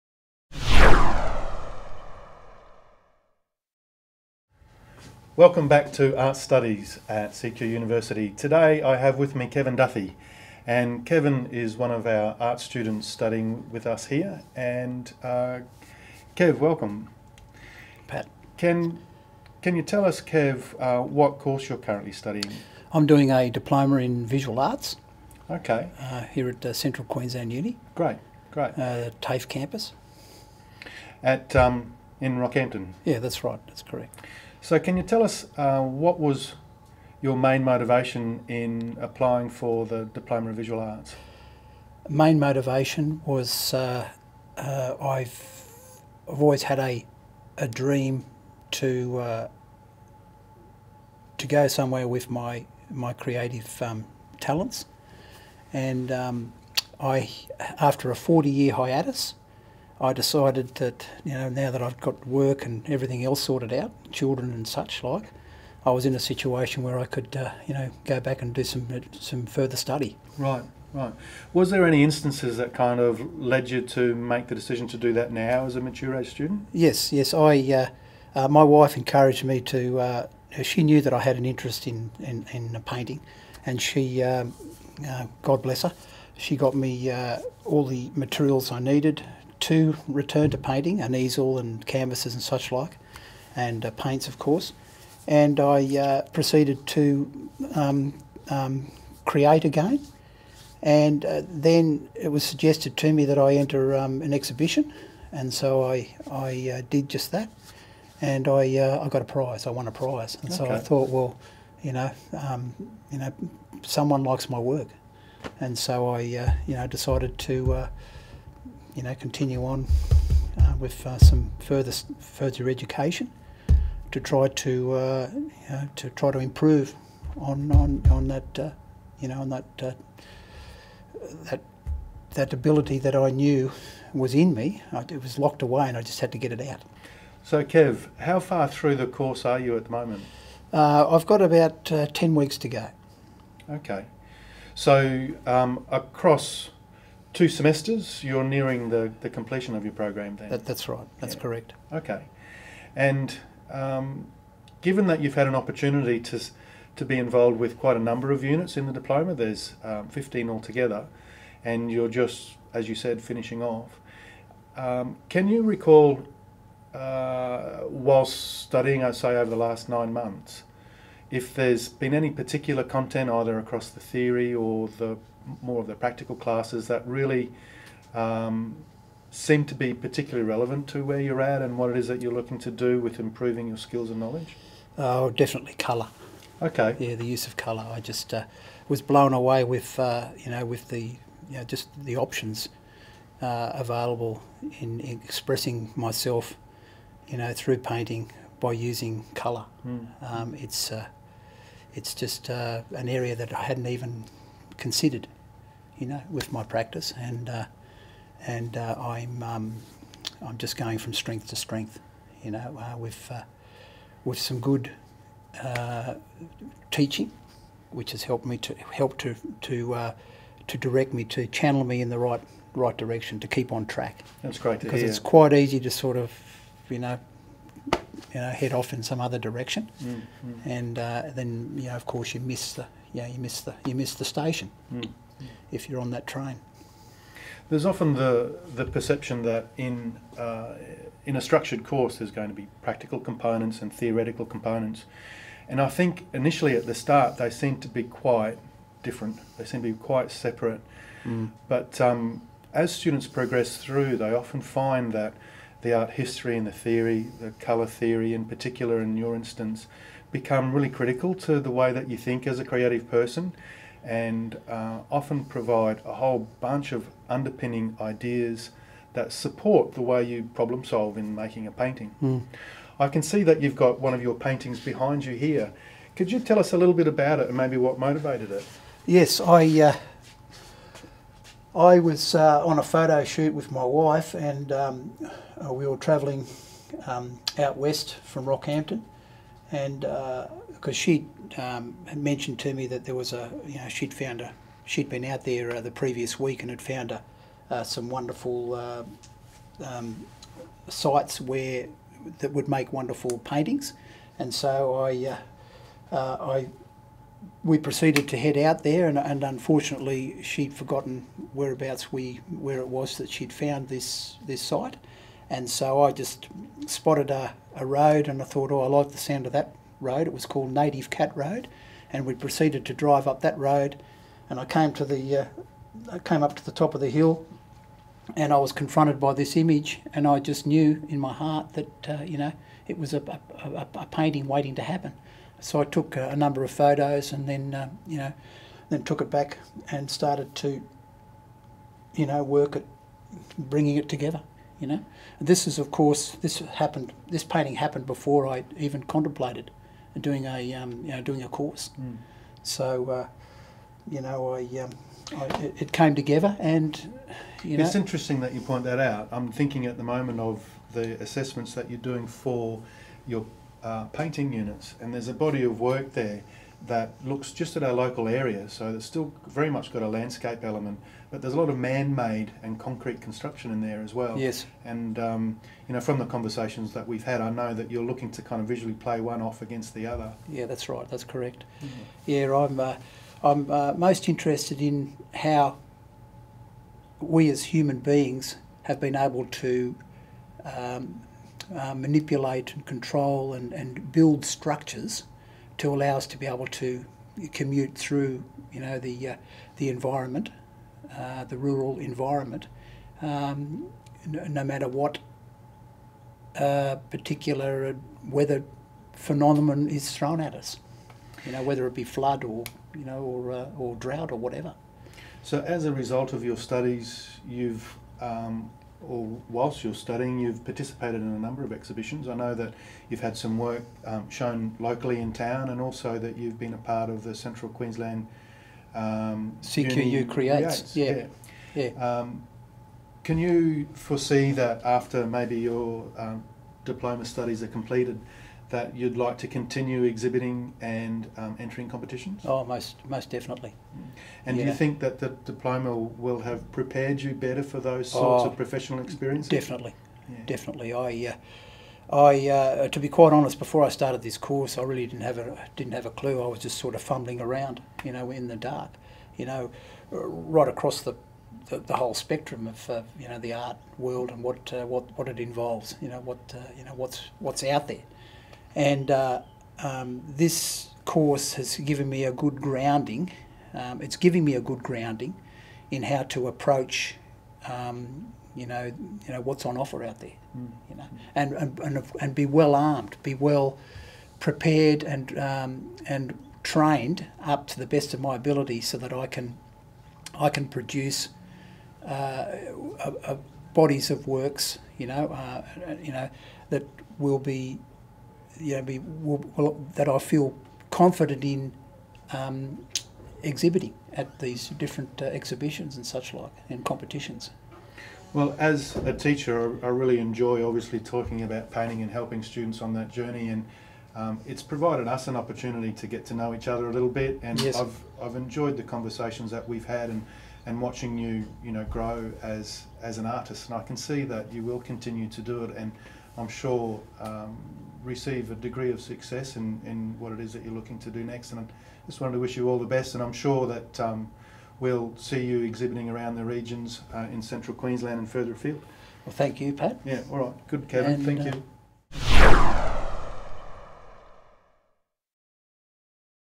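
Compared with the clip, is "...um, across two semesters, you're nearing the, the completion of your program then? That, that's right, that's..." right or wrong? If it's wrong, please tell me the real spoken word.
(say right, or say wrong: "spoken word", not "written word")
right.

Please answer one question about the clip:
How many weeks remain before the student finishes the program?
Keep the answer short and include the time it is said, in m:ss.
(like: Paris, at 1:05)
10, at 2:22.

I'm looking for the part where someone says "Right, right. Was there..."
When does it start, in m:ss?
1:10.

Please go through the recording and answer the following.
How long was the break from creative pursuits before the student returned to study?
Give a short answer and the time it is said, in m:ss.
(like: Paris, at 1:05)
40 years, at 0:58.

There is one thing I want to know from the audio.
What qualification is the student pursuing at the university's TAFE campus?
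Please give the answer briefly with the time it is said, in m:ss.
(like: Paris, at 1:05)
Diploma in visual arts, at 0:23.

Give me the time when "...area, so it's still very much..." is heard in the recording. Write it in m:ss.
6:08.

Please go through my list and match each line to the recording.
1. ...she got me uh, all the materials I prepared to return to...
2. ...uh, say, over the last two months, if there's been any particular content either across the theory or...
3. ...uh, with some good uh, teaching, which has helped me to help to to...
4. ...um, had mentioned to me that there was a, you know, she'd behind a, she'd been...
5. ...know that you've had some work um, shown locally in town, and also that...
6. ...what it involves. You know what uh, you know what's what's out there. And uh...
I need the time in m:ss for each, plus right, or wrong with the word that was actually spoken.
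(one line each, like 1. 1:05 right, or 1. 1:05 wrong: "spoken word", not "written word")
1. 1:26 wrong: "needed", not "prepared"
2. 2:49 wrong: "nine", not "two"
3. 3:33 right
4. 4:51 wrong: "found", not "behind"
5. 7:02 right
6. 7:45 right.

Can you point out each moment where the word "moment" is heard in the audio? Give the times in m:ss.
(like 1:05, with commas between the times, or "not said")
2:19, 6:00.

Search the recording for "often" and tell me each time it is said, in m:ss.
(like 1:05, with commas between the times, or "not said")
3:57, 4:14, 4:25.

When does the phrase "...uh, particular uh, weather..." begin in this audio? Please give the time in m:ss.
6:46.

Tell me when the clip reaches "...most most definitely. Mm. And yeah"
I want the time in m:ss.
7:22.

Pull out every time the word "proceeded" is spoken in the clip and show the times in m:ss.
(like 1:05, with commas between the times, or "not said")
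1:36, 5:07, 5:22.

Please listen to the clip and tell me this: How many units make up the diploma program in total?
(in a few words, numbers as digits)
15.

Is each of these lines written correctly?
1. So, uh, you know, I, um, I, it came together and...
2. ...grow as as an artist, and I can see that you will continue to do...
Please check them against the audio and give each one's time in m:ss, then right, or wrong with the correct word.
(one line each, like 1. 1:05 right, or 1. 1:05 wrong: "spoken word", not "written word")
1. 5:52 right
2. 8:41 right.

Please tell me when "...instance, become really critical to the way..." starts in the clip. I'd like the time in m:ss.
4:19.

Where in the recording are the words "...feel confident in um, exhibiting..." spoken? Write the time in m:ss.
8:20.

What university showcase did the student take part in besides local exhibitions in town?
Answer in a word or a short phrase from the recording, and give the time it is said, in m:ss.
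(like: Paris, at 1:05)
CQU Creates, at 7:09.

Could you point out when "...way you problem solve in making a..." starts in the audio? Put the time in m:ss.
4:30.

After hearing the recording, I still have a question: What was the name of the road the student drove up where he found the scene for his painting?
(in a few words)
Native Cat Road.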